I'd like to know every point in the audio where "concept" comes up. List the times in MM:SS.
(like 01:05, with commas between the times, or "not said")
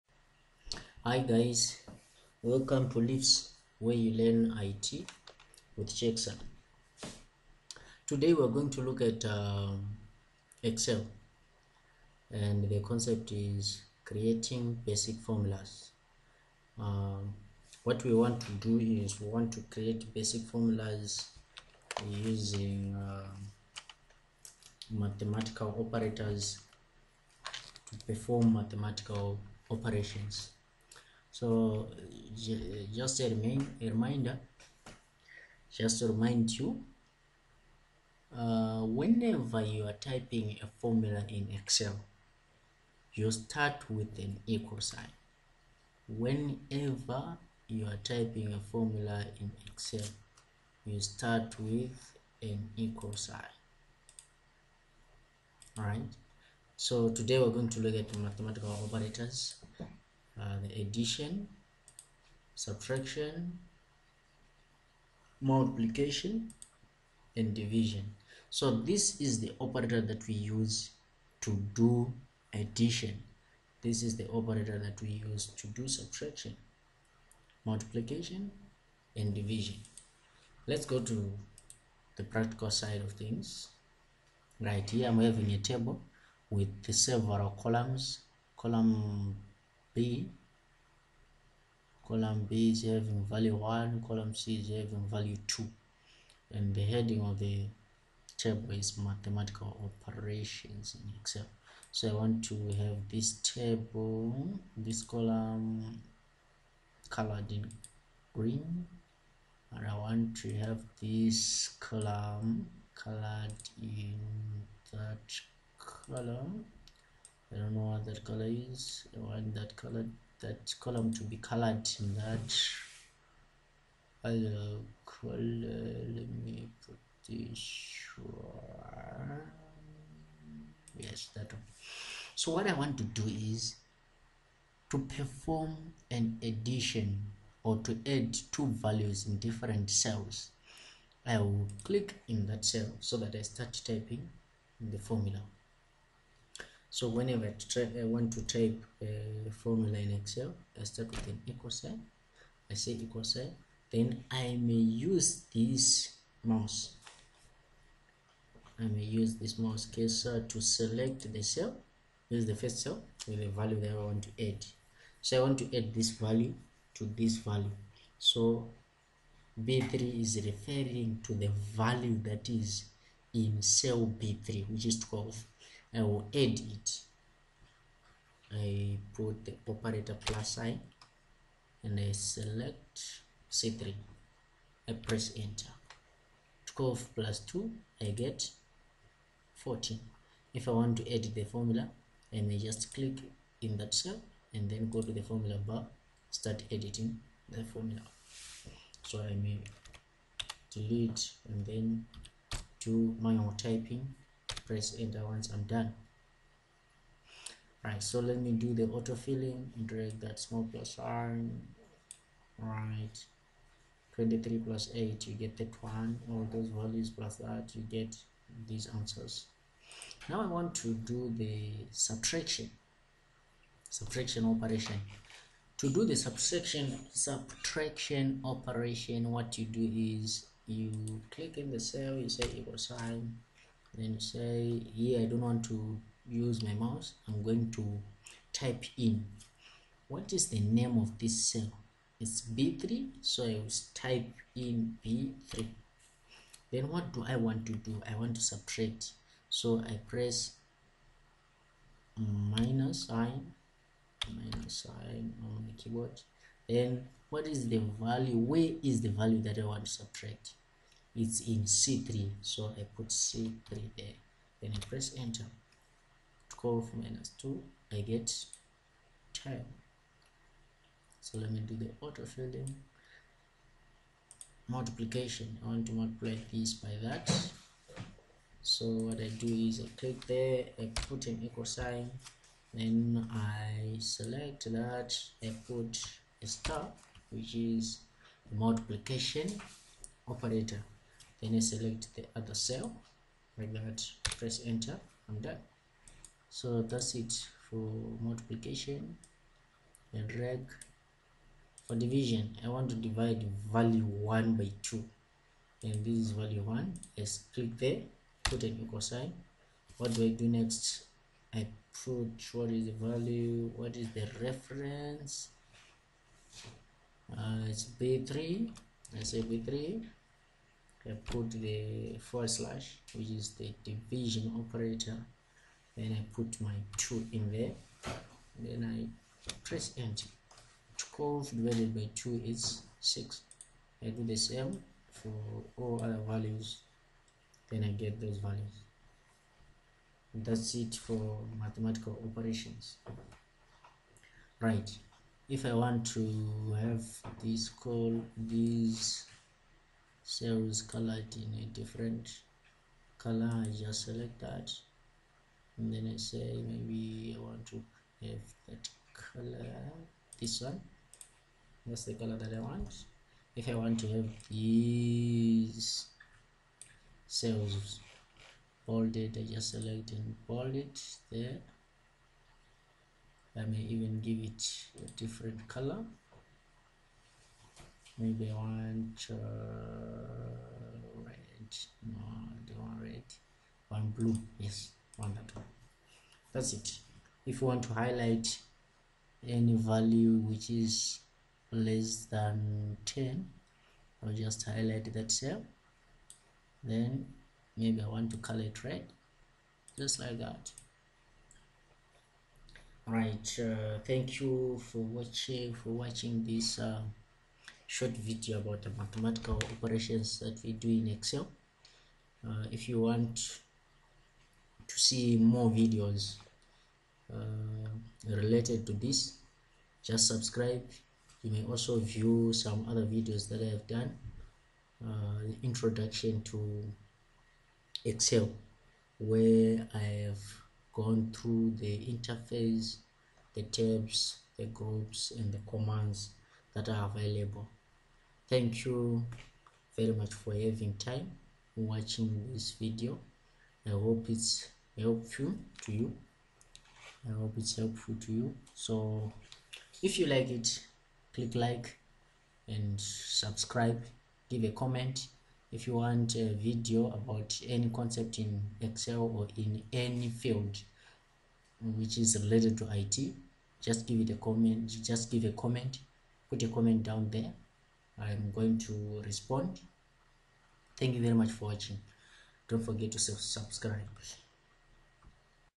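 00:12, 07:37.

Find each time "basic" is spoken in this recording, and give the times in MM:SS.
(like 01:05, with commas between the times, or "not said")
00:14, 00:20.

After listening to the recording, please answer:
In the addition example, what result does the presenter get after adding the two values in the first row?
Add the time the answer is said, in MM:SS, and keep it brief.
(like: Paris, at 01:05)
14, at 03:08.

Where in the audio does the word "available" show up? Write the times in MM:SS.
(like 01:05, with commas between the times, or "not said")
07:17.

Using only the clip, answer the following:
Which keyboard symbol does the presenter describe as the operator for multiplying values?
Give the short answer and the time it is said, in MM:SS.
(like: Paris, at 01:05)
star, at 04:46.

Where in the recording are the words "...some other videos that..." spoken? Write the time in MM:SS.
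07:02.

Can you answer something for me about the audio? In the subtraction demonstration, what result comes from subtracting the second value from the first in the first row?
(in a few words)
10.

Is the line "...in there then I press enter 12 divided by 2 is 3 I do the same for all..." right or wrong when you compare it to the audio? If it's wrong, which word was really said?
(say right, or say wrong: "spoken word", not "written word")
wrong: "6", not "3".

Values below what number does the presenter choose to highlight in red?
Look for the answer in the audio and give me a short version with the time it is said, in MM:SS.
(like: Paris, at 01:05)
10, at 06:31.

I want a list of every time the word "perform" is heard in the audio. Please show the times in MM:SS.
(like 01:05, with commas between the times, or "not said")
00:28, 02:14.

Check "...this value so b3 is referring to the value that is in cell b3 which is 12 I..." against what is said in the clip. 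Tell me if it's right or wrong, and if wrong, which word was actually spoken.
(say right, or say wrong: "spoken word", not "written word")
right.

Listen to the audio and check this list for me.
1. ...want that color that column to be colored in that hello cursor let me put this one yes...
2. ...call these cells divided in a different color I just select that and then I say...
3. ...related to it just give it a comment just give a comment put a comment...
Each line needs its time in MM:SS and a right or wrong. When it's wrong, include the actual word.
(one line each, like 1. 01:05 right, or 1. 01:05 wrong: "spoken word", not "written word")
1. 01:59 wrong: "color", not "cursor"
2. 05:47 wrong: "colored", not "divided"
3. 07:42 right.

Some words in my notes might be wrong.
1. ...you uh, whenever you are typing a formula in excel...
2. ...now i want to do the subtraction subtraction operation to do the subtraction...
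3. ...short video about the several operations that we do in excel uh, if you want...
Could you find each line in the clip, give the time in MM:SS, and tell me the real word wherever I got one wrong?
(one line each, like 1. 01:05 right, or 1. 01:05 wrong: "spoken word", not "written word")
1. 00:36 right
2. 03:40 right
3. 06:47 wrong: "mathematical", not "several".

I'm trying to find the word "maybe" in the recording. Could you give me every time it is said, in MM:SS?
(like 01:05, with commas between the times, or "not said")
05:56, 06:18, 06:37.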